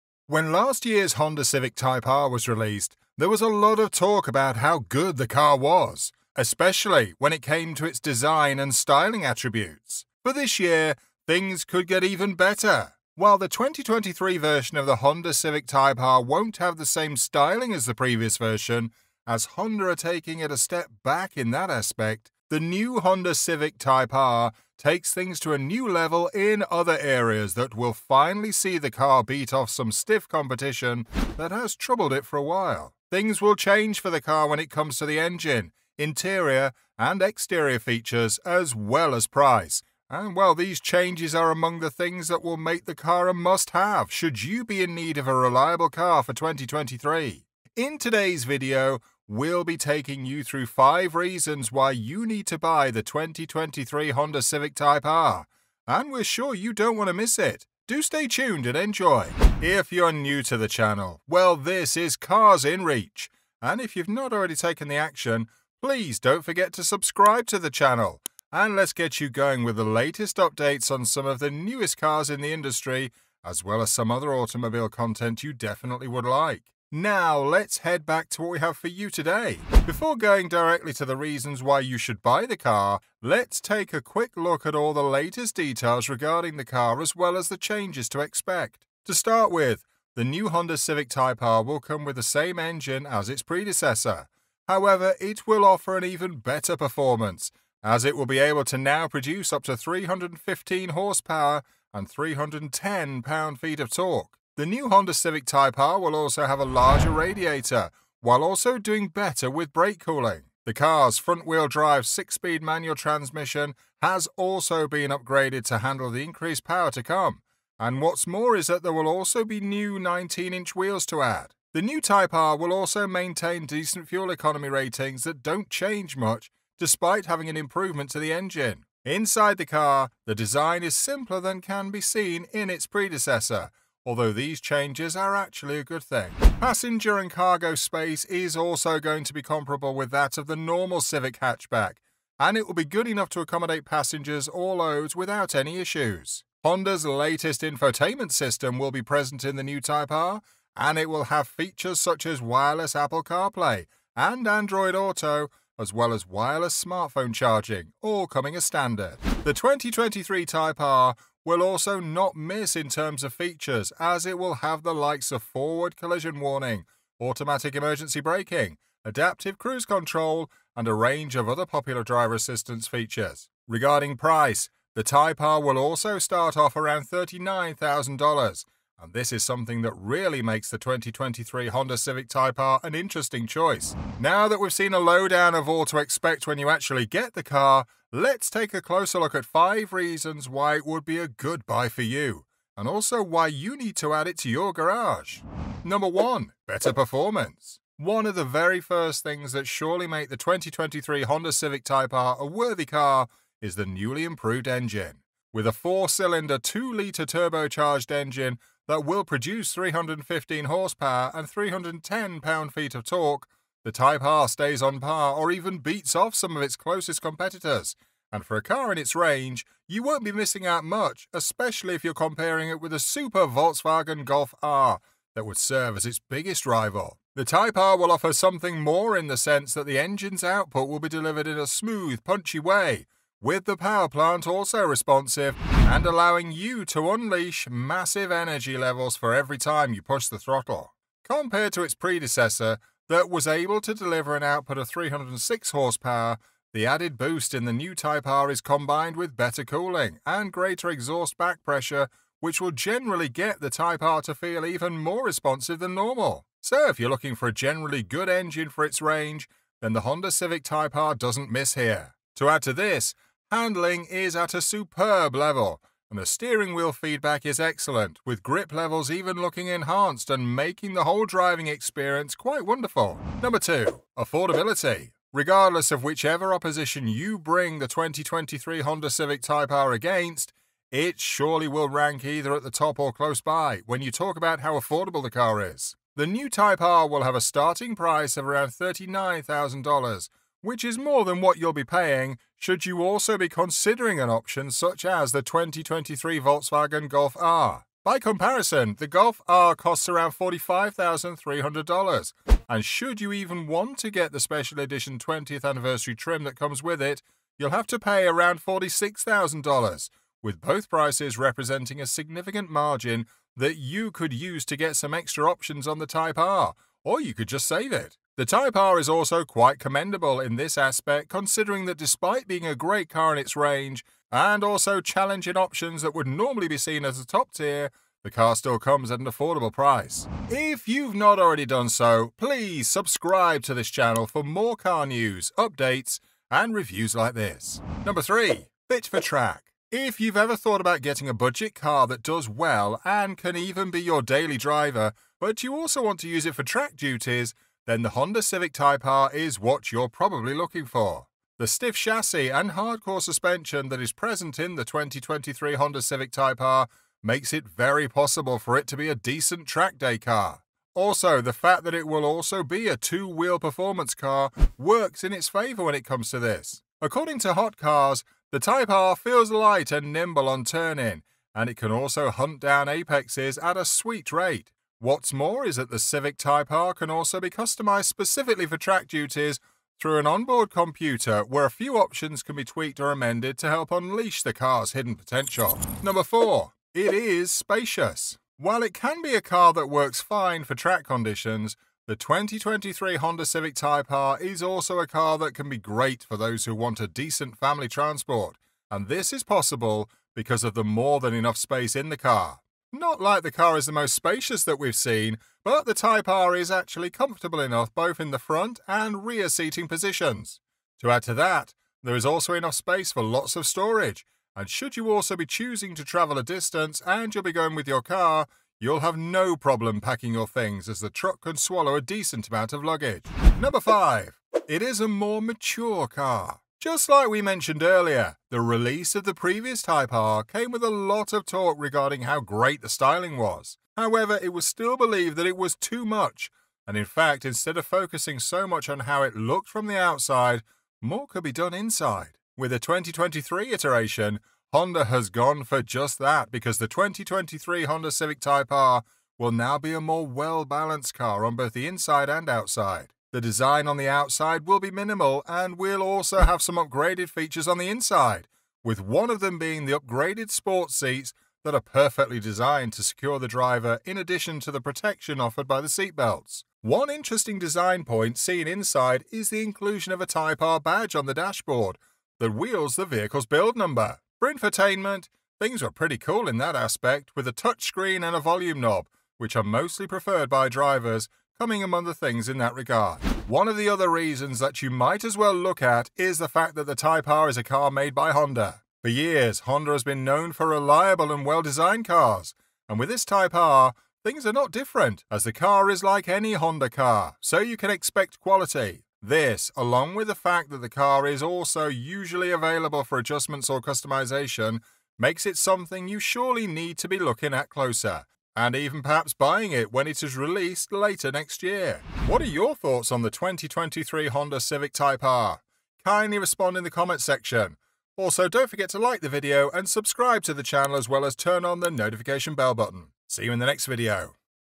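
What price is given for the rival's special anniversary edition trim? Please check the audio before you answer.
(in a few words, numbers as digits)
$46,000.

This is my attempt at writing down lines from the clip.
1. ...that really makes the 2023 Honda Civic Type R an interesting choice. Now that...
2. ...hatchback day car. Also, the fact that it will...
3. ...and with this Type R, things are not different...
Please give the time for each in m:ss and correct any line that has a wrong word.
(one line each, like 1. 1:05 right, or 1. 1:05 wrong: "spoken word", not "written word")
1. 2:59 right
2. 5:59 wrong: "track", not "hatchback"
3. 8:12 right.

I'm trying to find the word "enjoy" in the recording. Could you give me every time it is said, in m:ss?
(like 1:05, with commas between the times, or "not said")
0:58.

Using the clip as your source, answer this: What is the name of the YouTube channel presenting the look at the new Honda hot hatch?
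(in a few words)
Cars in Reach.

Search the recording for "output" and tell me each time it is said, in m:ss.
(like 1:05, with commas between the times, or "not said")
3:50, 4:04.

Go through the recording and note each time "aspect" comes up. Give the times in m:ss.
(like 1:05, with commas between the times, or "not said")
0:21, 5:20, 7:56.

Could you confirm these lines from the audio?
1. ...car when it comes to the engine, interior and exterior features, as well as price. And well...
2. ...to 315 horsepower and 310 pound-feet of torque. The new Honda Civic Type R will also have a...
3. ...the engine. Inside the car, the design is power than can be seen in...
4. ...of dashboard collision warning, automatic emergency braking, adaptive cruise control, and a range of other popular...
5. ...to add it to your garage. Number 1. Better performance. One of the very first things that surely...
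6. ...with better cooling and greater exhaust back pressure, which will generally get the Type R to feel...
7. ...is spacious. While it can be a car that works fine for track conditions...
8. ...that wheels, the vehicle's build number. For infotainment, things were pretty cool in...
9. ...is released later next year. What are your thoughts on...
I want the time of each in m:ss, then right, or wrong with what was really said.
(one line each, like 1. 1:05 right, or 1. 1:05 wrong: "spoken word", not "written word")
1. 0:34 right
2. 1:39 right
3. 2:08 wrong: "simpler", not "power"
4. 2:45 wrong: "forward", not "dashboard"
5. 3:13 right
6. 4:09 right
7. 6:27 right
8. 7:52 right
9. 8:30 right.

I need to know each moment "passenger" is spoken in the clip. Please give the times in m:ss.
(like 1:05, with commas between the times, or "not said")
2:16, 2:23.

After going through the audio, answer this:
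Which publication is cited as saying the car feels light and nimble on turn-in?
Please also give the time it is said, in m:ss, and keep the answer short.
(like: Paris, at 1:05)
Hot Cars, at 6:07.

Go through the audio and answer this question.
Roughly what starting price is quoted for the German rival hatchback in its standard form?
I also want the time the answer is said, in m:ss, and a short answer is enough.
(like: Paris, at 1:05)
$45,300, at 5:00.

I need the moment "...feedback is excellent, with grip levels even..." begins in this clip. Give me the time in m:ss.
4:26.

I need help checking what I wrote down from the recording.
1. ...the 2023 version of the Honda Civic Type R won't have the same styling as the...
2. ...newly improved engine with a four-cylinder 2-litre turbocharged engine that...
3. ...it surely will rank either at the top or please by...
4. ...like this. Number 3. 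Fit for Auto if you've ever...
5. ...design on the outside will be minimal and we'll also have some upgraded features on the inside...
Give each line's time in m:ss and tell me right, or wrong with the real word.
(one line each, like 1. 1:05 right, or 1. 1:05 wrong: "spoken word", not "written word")
1. 0:13 right
2. 3:23 right
3. 4:40 wrong: "close", not "please"
4. 5:37 wrong: "Track", not "Auto"
5. 7:33 right.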